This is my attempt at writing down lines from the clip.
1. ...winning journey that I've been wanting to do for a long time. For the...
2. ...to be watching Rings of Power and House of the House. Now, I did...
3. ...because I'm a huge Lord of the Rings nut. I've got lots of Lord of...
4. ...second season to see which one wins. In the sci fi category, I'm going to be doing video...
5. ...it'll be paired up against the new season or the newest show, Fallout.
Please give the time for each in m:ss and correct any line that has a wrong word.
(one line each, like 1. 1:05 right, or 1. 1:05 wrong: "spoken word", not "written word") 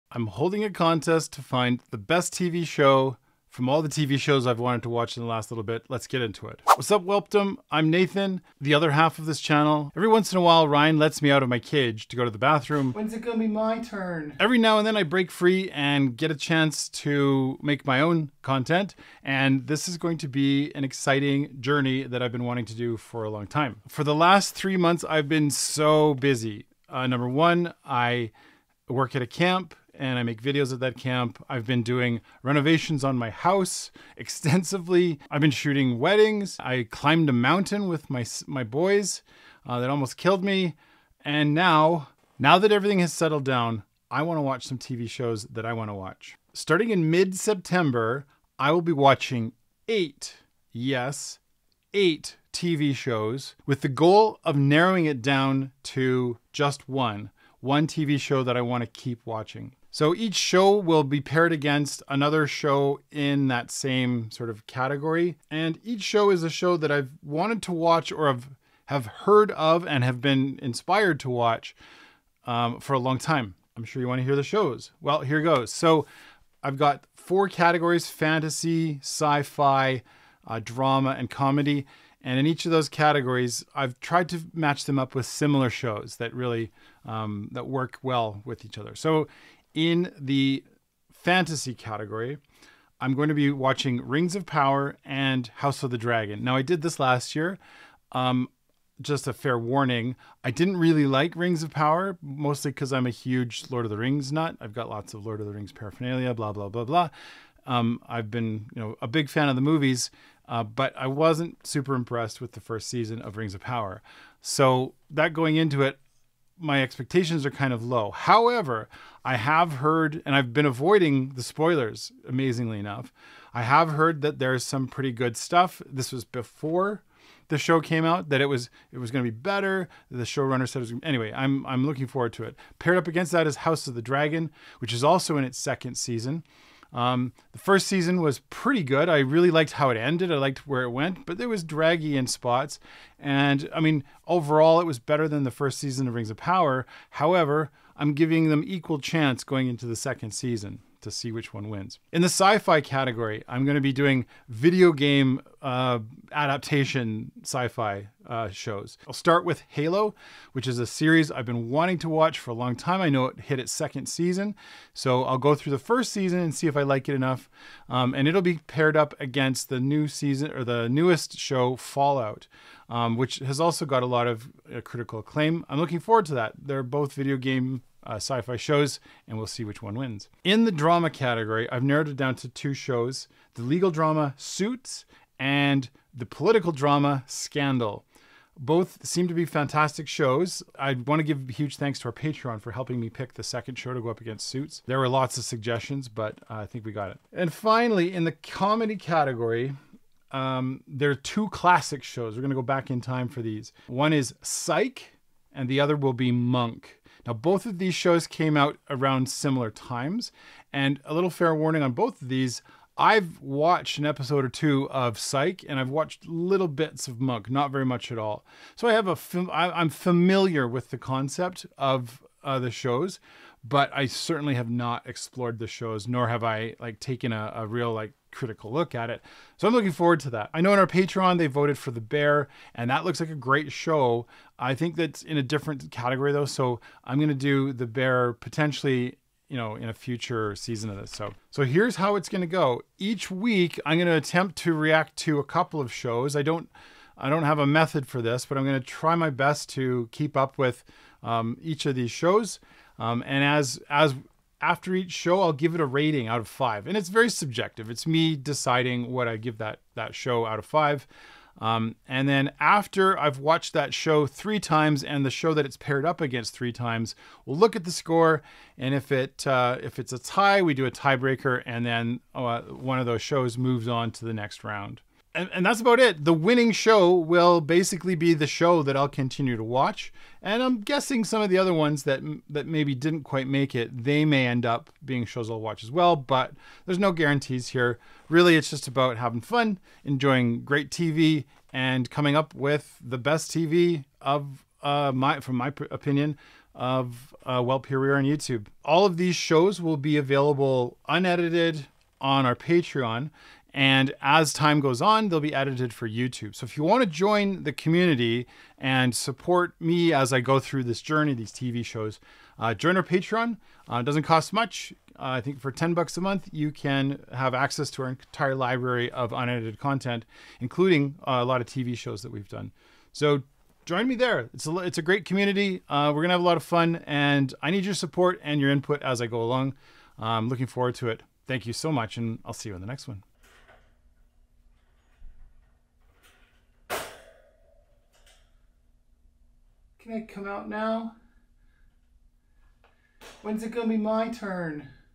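1. 0:20 wrong: "exciting", not "winning"
2. 1:33 wrong: "Dragon", not "House"
3. 1:42 right
4. 2:29 right
5. 2:48 right.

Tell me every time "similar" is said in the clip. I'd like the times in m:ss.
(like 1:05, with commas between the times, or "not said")
1:25, 3:29.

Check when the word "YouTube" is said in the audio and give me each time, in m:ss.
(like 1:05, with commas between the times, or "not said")
4:58, 5:06.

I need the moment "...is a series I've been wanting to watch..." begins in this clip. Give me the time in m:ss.
2:40.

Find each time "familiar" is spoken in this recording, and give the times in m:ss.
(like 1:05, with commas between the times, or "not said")
3:39.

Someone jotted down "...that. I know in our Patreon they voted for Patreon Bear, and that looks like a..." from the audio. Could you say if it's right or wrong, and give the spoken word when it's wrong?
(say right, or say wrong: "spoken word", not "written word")
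wrong: "The", not "Patreon".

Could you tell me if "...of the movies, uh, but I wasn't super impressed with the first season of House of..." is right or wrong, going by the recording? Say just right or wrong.
wrong.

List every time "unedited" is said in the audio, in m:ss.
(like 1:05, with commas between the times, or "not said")
5:01, 5:19.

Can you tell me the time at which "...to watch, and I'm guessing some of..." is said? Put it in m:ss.
4:39.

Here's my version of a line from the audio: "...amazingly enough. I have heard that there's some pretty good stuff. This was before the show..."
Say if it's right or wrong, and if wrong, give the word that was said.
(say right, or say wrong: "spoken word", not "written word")
right.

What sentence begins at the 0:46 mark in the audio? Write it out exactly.
Starting in mid-September, I will be watching 8.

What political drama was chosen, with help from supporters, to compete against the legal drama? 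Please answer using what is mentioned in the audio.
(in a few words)
Scandal.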